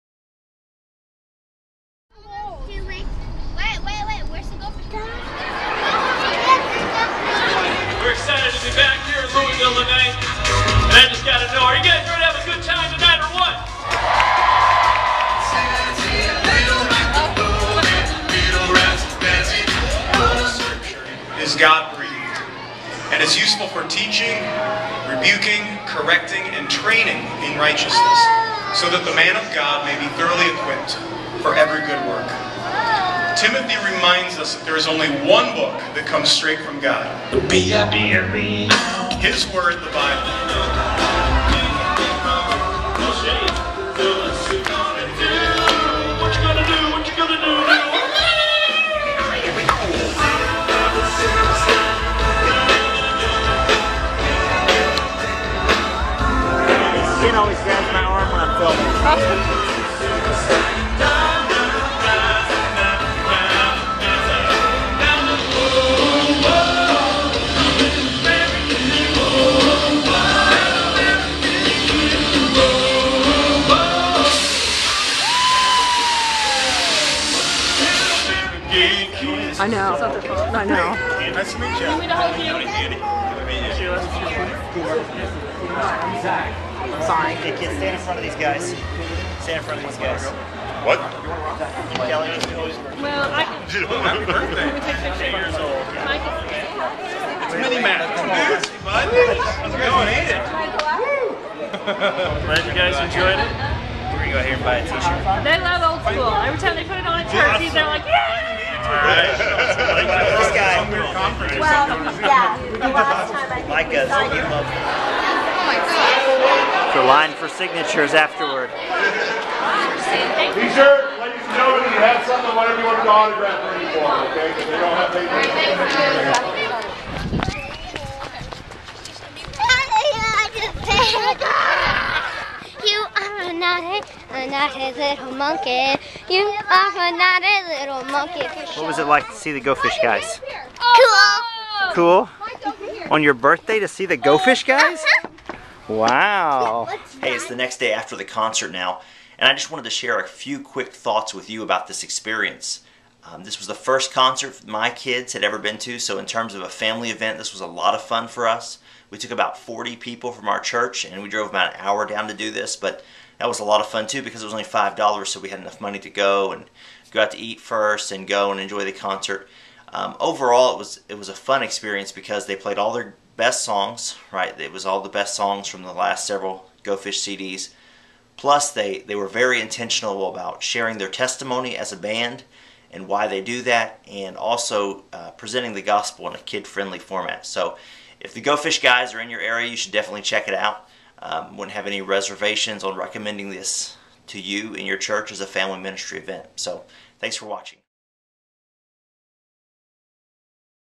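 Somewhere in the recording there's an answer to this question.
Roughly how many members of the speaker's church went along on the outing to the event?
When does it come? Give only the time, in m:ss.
2:39.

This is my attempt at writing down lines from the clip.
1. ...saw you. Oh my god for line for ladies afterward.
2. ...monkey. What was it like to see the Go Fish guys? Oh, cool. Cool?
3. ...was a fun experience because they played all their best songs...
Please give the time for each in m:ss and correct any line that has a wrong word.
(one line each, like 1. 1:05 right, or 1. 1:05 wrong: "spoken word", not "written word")
1. 1:54 wrong: "signatures", not "ladies"
2. 2:18 right
3. 2:51 right.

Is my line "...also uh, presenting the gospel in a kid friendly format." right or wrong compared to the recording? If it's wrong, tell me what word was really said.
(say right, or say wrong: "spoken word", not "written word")
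right.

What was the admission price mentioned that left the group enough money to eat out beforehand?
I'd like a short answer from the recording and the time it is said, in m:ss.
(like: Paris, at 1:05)
$5, at 2:44.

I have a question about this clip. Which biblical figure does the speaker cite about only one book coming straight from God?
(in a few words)
Timothy.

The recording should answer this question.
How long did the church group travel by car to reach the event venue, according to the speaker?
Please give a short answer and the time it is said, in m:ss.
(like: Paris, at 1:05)
an hour, at 2:41.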